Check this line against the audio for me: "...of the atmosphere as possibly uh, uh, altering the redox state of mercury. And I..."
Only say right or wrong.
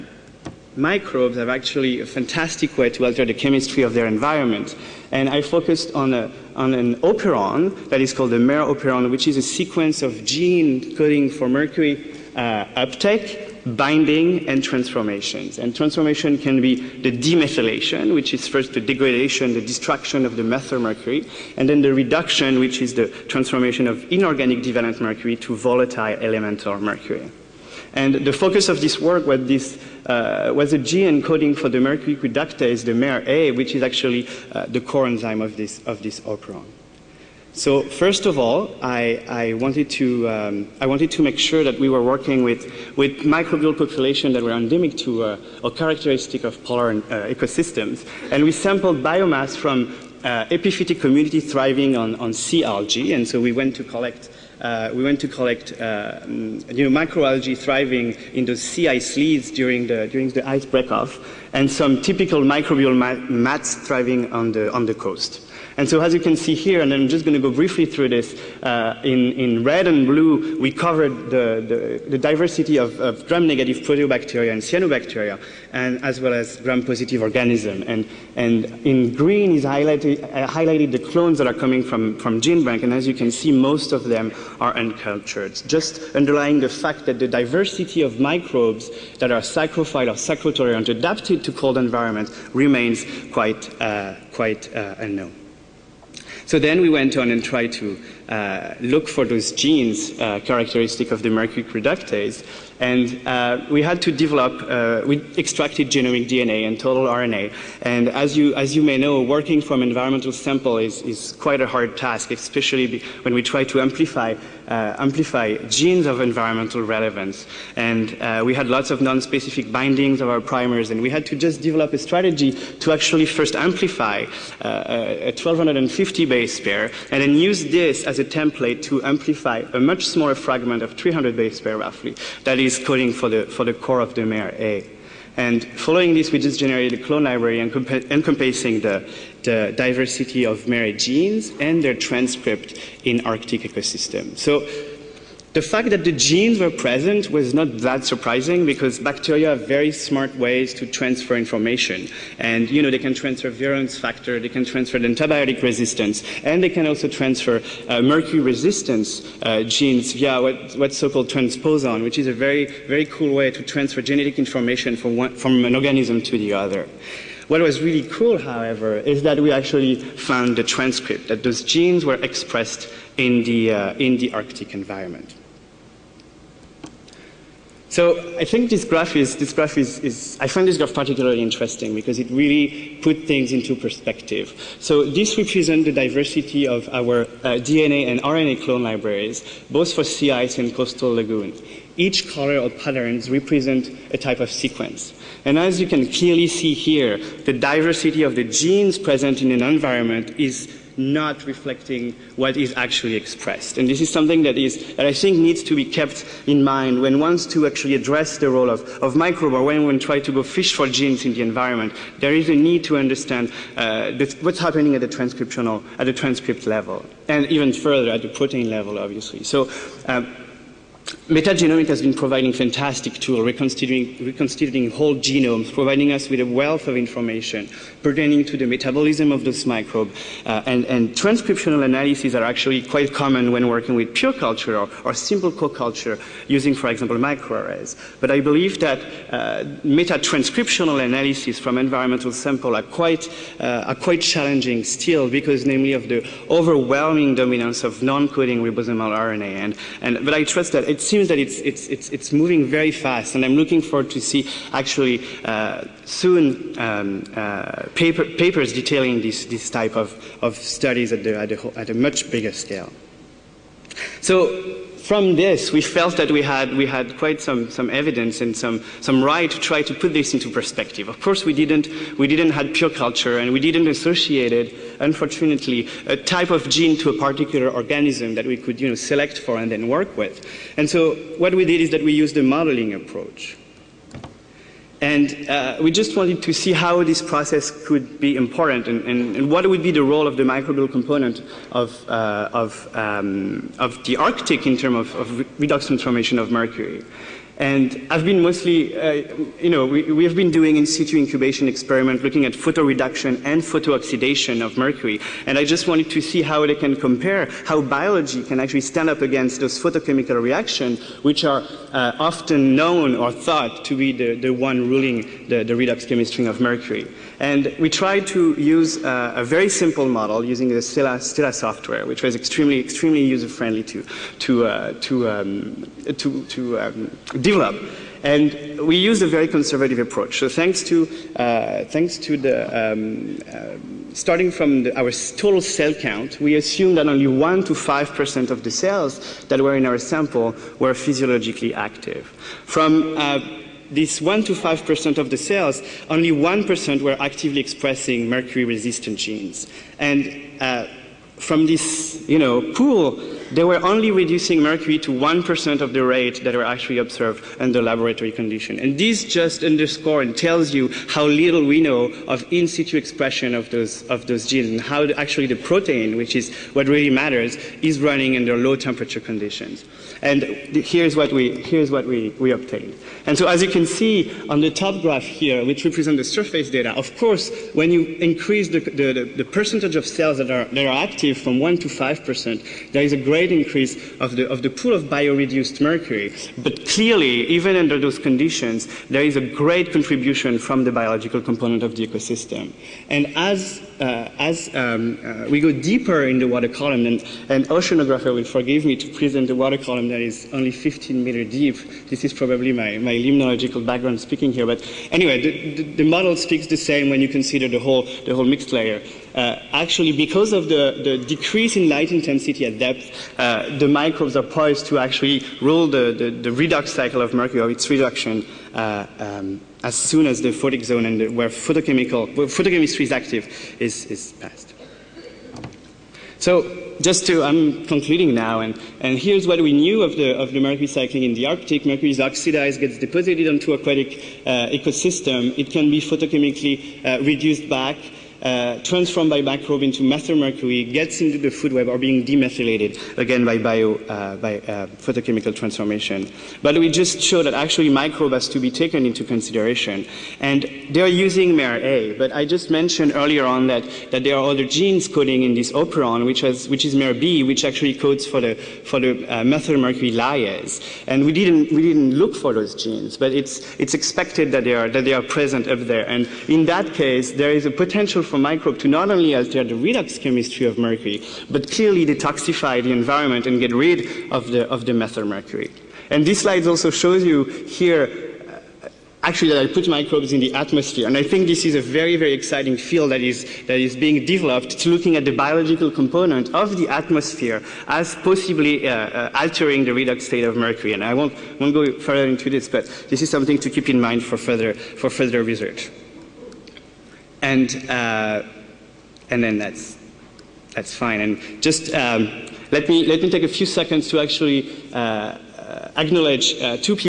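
right.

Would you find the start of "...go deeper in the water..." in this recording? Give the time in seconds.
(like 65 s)
395 s.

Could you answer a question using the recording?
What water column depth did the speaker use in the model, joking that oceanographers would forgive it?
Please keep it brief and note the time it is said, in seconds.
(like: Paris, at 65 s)
15 meters, at 400 s.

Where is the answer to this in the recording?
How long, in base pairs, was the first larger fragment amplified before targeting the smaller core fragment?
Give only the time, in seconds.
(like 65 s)
125 s.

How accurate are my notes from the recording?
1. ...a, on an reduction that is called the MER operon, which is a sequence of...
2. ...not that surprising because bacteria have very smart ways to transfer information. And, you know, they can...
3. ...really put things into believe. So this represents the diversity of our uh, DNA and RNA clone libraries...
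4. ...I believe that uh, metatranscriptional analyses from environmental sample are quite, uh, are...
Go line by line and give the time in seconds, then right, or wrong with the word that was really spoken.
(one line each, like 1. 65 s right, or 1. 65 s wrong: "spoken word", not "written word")
1. 6 s wrong: "operon", not "reduction"
2. 147 s right
3. 182 s wrong: "perspective", not "believe"
4. 238 s right.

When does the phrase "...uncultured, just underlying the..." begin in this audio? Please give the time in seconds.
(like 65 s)
84 s.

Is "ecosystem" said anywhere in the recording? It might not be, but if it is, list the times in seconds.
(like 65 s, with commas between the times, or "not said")
47 s, 143 s, 392 s, 434 s.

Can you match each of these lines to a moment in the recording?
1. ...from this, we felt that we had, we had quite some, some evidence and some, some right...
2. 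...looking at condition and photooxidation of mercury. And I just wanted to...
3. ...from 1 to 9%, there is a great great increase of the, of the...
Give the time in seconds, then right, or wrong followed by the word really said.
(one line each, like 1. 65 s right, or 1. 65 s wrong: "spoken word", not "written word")
1. 265 s right
2. 302 s wrong: "photoreduction", not "condition"
3. 381 s wrong: "5", not "9".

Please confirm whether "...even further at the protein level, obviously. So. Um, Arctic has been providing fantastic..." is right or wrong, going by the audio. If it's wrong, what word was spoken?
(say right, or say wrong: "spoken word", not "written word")
wrong: "Metagenomics", not "Arctic".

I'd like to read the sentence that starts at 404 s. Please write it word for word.
But anyway, the, the, the model speaks the same when you consider the whole, the whole mixed layer.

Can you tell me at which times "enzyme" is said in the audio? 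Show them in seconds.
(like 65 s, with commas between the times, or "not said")
35 s.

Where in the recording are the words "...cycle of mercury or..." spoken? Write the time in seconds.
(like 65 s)
416 s.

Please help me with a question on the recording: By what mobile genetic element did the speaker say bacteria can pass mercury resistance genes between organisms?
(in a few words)
transposon.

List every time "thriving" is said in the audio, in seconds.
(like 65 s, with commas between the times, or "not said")
51 s, 57 s, 63 s.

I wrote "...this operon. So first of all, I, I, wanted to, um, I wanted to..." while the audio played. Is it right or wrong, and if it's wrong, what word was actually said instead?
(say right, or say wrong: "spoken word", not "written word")
right.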